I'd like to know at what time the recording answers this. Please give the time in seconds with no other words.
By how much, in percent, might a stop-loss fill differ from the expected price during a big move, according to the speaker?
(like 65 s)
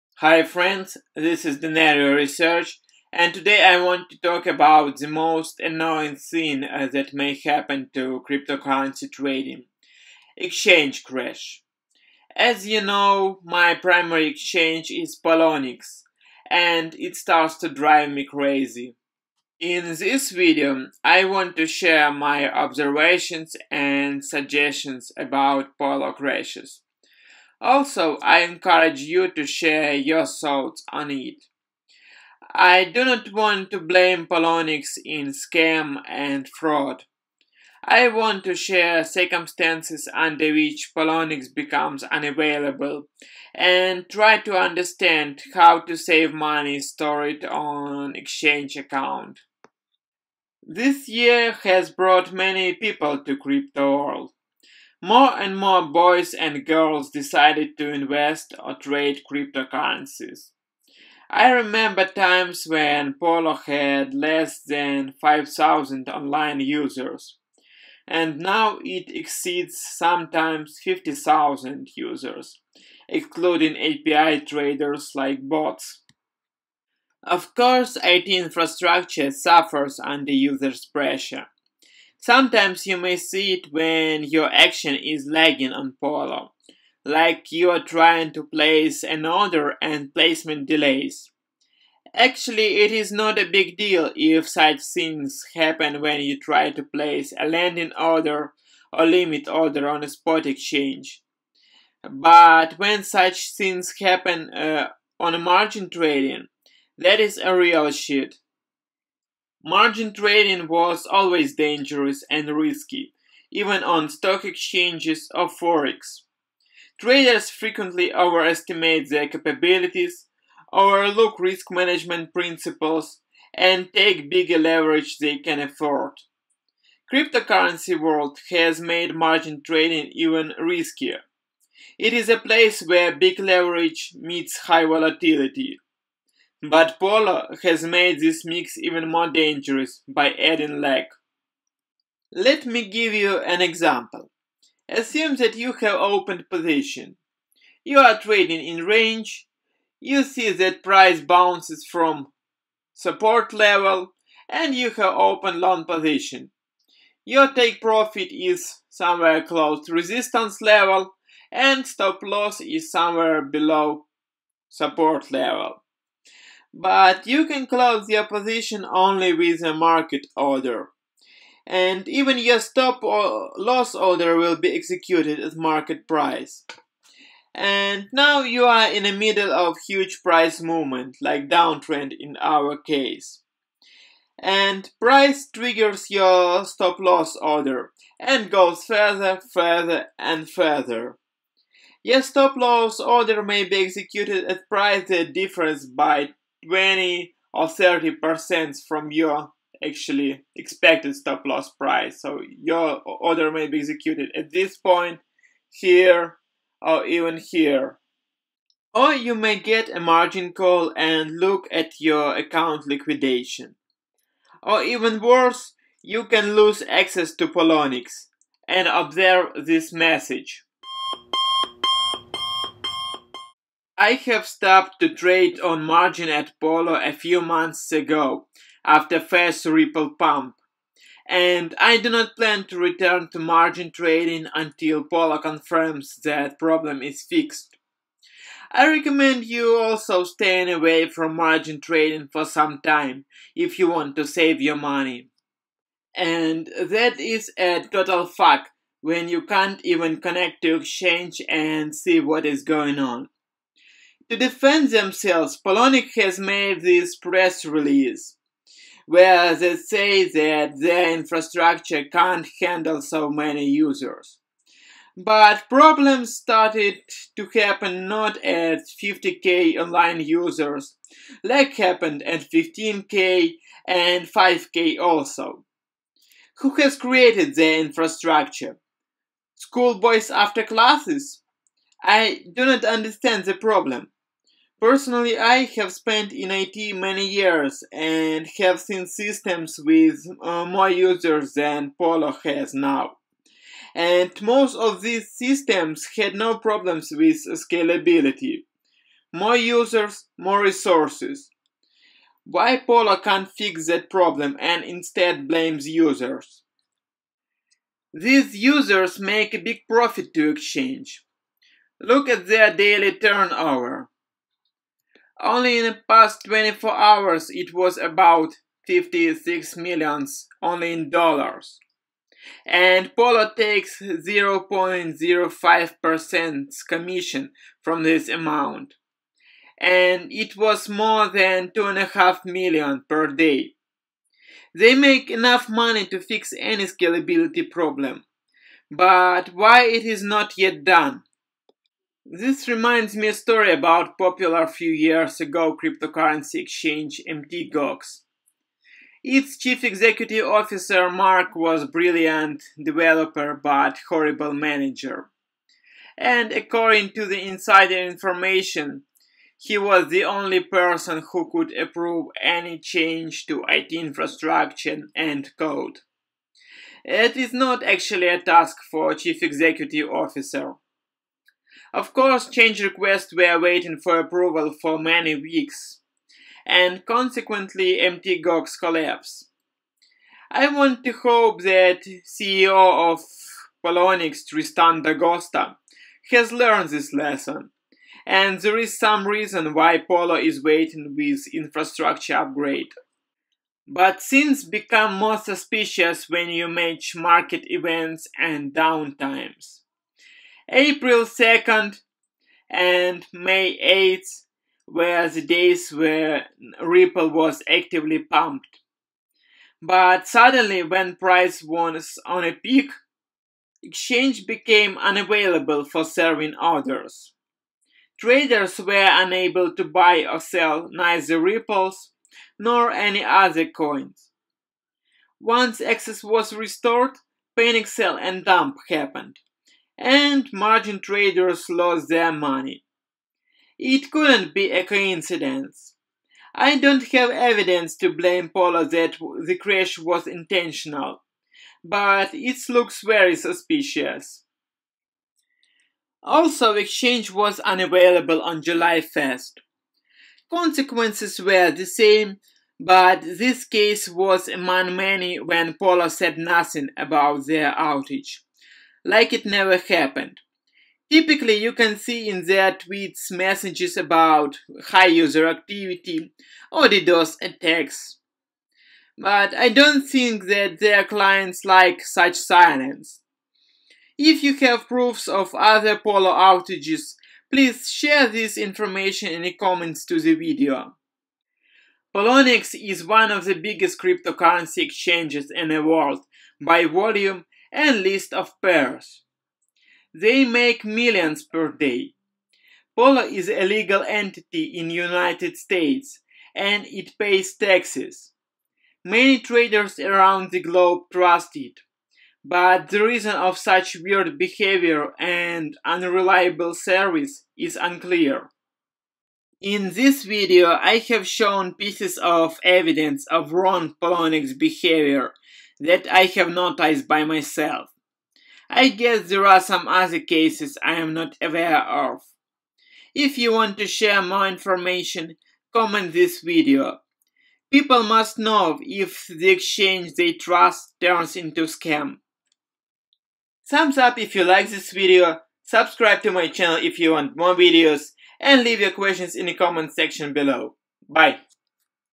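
196 s.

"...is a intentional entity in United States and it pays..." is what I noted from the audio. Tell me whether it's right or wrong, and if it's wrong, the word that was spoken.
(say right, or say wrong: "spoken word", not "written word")
wrong: "legal", not "intentional".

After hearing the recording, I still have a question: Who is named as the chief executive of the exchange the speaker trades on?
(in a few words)
Tristan D'Agosta.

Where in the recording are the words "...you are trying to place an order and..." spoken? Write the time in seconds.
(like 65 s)
87 s.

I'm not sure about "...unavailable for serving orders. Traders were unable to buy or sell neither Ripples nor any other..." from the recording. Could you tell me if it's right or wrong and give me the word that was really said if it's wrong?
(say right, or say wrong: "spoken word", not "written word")
right.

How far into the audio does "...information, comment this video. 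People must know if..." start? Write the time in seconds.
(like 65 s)
524 s.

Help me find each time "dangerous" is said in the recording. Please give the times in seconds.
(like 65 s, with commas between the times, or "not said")
111 s, 139 s.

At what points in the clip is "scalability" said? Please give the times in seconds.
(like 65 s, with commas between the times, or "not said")
297 s, 336 s.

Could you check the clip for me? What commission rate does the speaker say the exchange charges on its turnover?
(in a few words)
0.05%.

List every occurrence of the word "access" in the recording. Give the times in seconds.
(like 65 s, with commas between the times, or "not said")
216 s, 425 s.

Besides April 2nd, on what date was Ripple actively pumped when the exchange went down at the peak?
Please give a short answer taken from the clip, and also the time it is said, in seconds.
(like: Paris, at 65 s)
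May 8th, at 403 s.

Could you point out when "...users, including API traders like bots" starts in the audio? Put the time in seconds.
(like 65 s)
71 s.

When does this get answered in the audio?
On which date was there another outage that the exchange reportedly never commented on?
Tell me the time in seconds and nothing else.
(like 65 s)
448 s.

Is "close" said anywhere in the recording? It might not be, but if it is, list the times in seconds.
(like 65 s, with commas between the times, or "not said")
159 s, 167 s.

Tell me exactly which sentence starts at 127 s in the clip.
Cryptocurrency world has made margin trading even riskier.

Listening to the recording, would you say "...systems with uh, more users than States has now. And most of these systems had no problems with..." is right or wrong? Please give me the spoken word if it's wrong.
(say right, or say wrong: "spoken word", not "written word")
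wrong: "Polo", not "States".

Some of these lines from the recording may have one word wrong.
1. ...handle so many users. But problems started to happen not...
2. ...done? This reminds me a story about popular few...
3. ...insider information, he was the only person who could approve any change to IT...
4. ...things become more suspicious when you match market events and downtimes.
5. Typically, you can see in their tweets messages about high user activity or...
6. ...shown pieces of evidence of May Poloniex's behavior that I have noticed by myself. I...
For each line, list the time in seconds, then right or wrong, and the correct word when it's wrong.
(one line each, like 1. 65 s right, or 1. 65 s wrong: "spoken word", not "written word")
1. 262 s right
2. 340 s right
3. 357 s right
4. 394 s right
5. 461 s right
6. 511 s wrong: "Ron", not "May".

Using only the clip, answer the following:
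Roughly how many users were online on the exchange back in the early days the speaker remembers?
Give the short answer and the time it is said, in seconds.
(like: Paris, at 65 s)
Less than 5,000, at 64 s.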